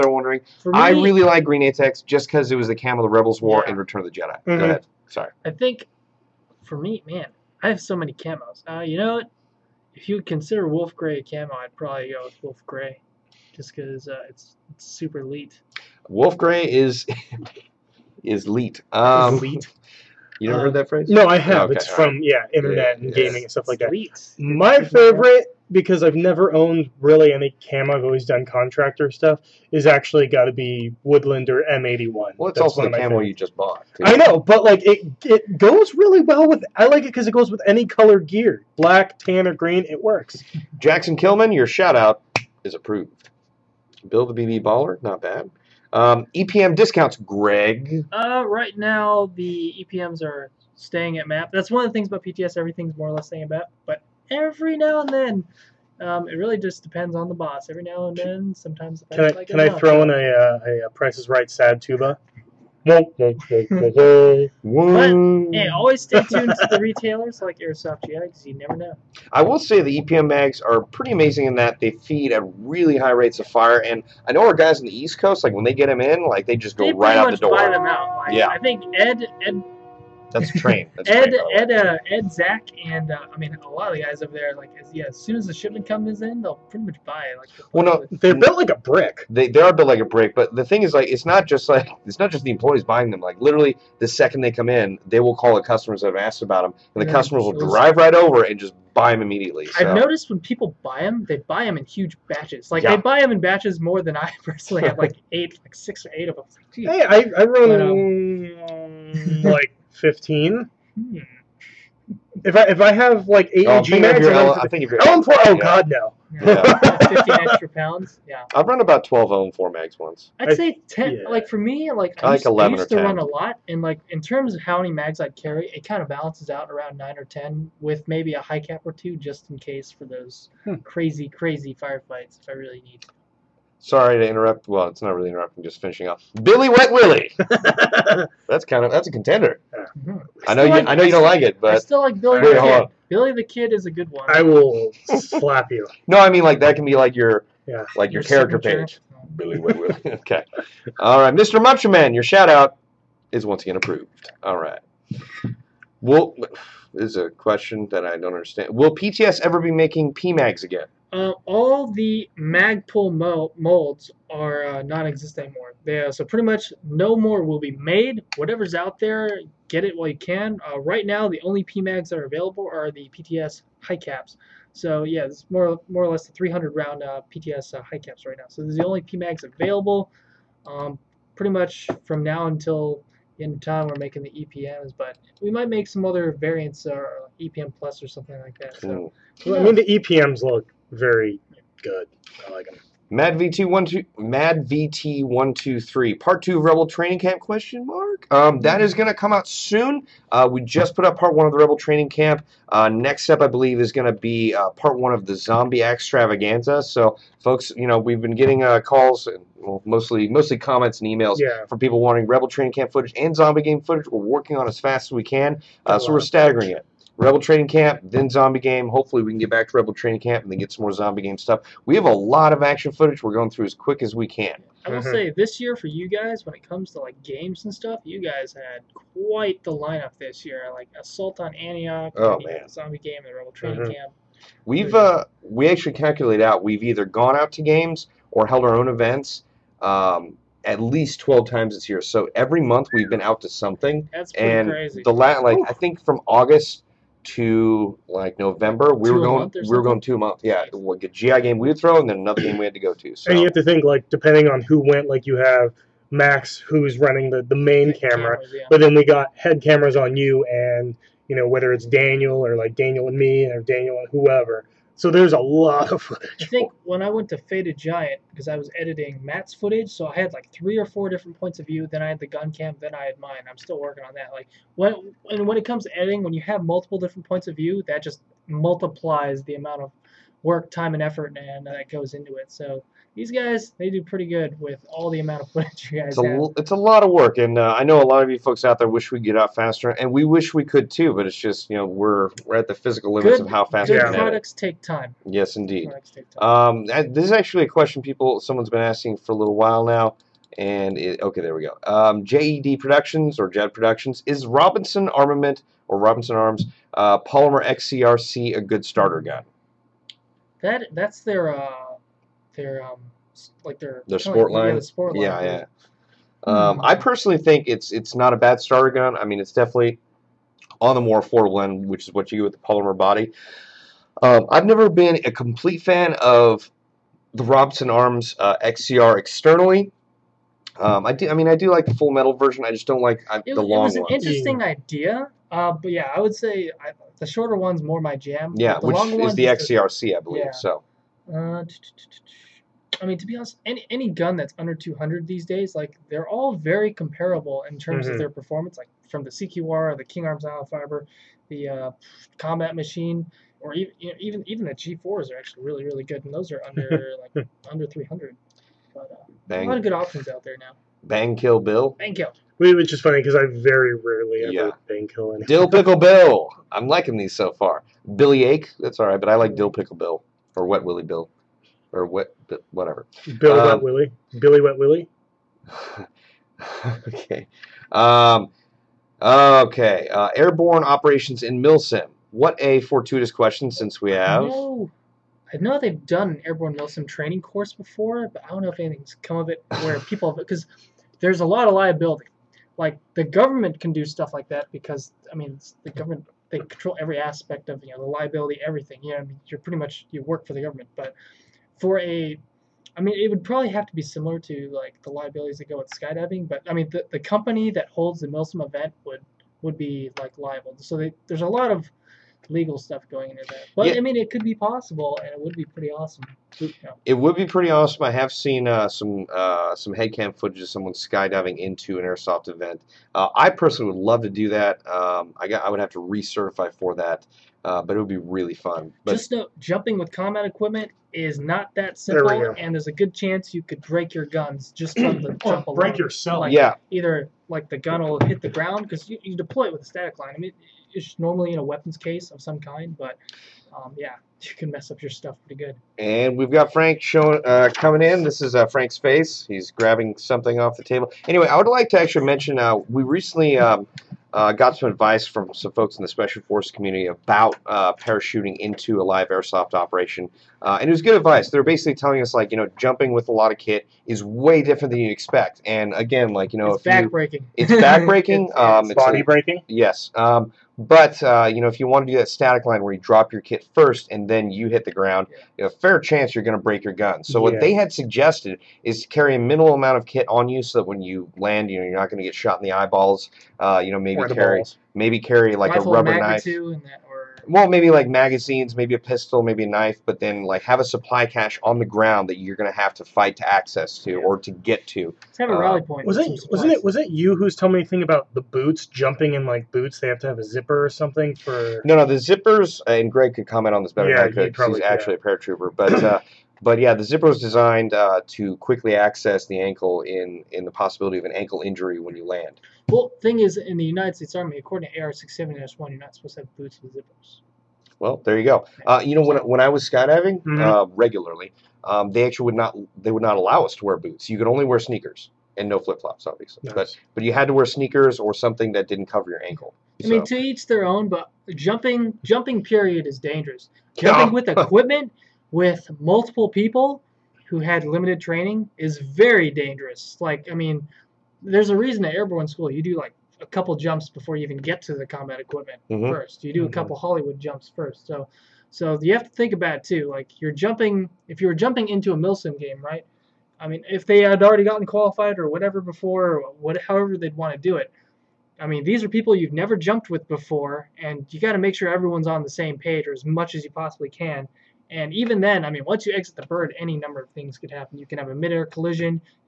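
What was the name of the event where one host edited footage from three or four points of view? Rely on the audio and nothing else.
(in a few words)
Faded Giant.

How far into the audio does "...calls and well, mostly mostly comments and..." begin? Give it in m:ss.
3:28.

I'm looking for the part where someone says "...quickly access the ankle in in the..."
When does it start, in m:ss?
8:28.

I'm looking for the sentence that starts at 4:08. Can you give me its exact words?
We two were going, we were going two months.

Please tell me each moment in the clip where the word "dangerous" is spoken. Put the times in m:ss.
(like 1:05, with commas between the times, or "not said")
8:53, 8:59.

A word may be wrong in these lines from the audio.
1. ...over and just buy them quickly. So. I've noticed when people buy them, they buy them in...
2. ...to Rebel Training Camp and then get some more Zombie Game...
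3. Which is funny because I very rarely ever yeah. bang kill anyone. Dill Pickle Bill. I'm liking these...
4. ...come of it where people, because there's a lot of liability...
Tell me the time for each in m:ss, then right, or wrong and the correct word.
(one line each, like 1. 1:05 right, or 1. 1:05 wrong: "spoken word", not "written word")
1. 1:38 wrong: "immediately", not "quickly"
2. 3:39 right
3. 6:02 right
4. 6:29 right.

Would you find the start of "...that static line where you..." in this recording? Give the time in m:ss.
7:52.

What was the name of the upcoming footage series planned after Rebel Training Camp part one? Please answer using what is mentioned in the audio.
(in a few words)
Zombie Extravaganza.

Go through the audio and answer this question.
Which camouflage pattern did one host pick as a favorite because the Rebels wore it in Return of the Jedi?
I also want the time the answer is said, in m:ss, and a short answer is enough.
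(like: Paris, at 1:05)
Green Atex, at 0:01.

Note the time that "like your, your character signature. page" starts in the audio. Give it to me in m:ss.
2:27.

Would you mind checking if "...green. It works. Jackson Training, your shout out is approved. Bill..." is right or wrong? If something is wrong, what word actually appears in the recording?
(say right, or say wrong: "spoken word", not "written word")
wrong: "Kilman", not "Training".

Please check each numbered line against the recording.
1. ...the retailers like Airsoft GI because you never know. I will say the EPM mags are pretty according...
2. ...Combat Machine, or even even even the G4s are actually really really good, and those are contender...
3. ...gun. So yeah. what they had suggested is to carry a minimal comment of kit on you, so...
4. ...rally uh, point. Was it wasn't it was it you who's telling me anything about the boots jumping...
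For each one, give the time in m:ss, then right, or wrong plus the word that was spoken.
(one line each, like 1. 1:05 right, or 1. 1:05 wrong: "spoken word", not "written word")
1. 1:06 wrong: "amazing", not "according"
2. 5:52 wrong: "under", not "contender"
3. 7:56 wrong: "amount", not "comment"
4. 8:15 right.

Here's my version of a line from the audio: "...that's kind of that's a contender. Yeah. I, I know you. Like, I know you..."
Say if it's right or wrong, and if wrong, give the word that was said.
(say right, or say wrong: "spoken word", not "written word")
right.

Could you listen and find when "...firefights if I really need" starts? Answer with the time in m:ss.
2:11.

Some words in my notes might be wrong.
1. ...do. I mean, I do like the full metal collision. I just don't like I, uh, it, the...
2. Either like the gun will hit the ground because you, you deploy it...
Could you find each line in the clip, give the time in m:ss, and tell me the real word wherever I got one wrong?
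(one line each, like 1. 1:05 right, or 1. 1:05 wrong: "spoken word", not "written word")
1. 5:31 wrong: "version", not "collision"
2. 7:16 right.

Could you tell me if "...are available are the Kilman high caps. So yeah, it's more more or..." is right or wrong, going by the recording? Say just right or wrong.
wrong.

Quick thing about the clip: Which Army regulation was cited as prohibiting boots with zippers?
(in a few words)
AR-67-1.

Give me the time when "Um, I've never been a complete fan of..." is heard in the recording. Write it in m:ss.
5:24.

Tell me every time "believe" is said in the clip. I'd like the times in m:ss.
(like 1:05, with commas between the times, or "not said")
3:23, 5:40.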